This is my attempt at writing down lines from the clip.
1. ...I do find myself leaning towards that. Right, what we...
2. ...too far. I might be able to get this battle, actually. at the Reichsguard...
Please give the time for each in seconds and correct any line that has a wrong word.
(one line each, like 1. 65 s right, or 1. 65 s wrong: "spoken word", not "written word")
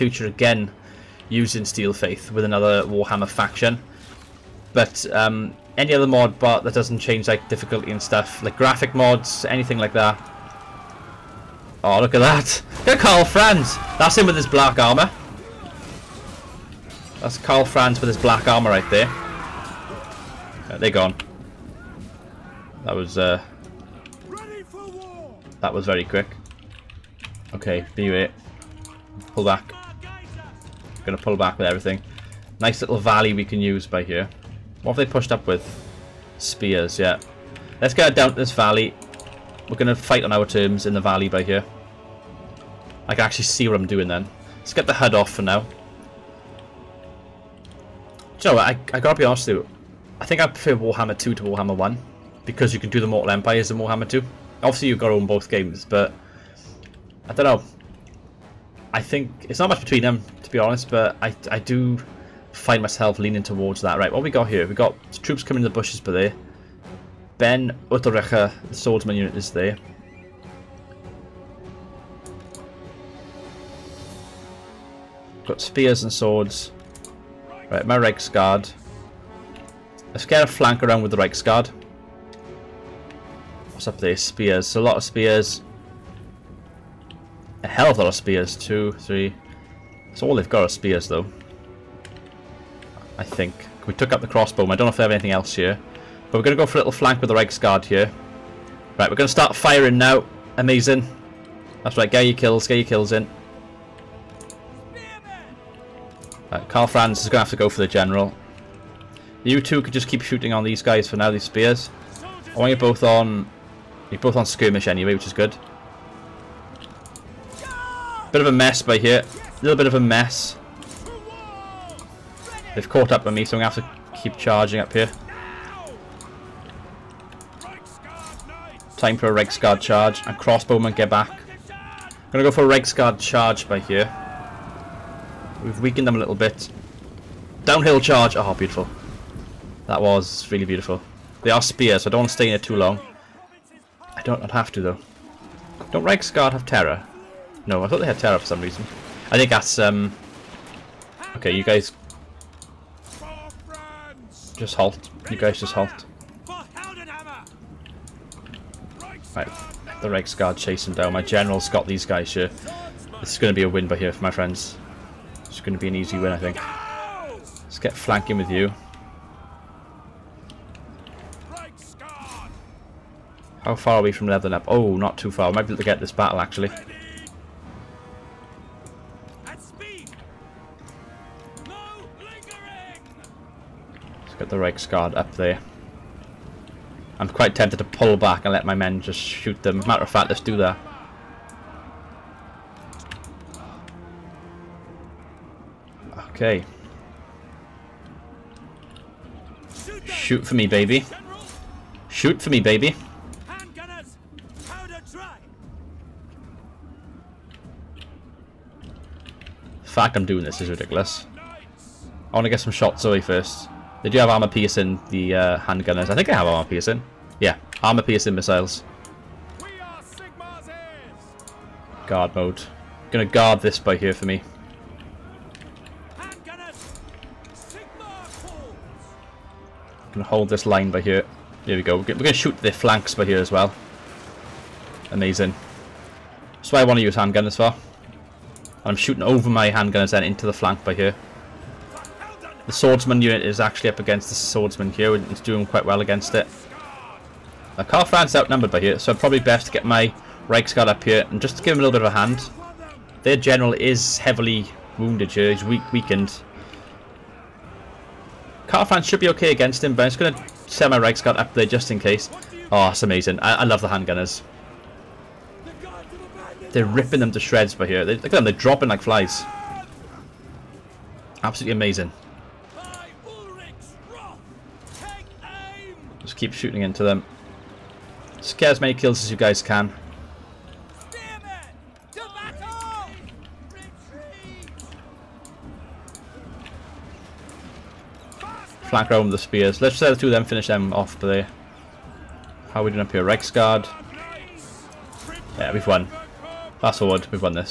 1. 61 s right
2. 175 s right.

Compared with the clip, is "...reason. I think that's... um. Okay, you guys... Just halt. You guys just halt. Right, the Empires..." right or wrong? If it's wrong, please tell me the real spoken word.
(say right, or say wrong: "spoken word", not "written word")
wrong: "Reichsguard", not "Empires".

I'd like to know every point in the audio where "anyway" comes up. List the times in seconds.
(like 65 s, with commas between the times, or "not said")
114 s.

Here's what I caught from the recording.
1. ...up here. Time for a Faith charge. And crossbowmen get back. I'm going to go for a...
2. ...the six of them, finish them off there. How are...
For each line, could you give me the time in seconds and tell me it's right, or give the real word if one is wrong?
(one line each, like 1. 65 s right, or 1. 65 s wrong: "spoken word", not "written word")
1. 124 s wrong: "Reg", not "Faith"
2. 290 s wrong: "two", not "six".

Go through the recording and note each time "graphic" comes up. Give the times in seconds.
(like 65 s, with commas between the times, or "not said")
8 s.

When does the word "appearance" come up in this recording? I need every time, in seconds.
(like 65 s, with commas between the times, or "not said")
not said.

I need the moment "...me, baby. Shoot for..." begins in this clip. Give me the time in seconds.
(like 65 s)
200 s.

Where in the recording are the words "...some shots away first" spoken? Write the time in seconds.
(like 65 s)
212 s.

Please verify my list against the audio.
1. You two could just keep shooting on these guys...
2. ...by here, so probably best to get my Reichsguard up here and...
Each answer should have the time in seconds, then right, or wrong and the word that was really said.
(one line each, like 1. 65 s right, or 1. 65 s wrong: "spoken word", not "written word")
1. 109 s right
2. 248 s right.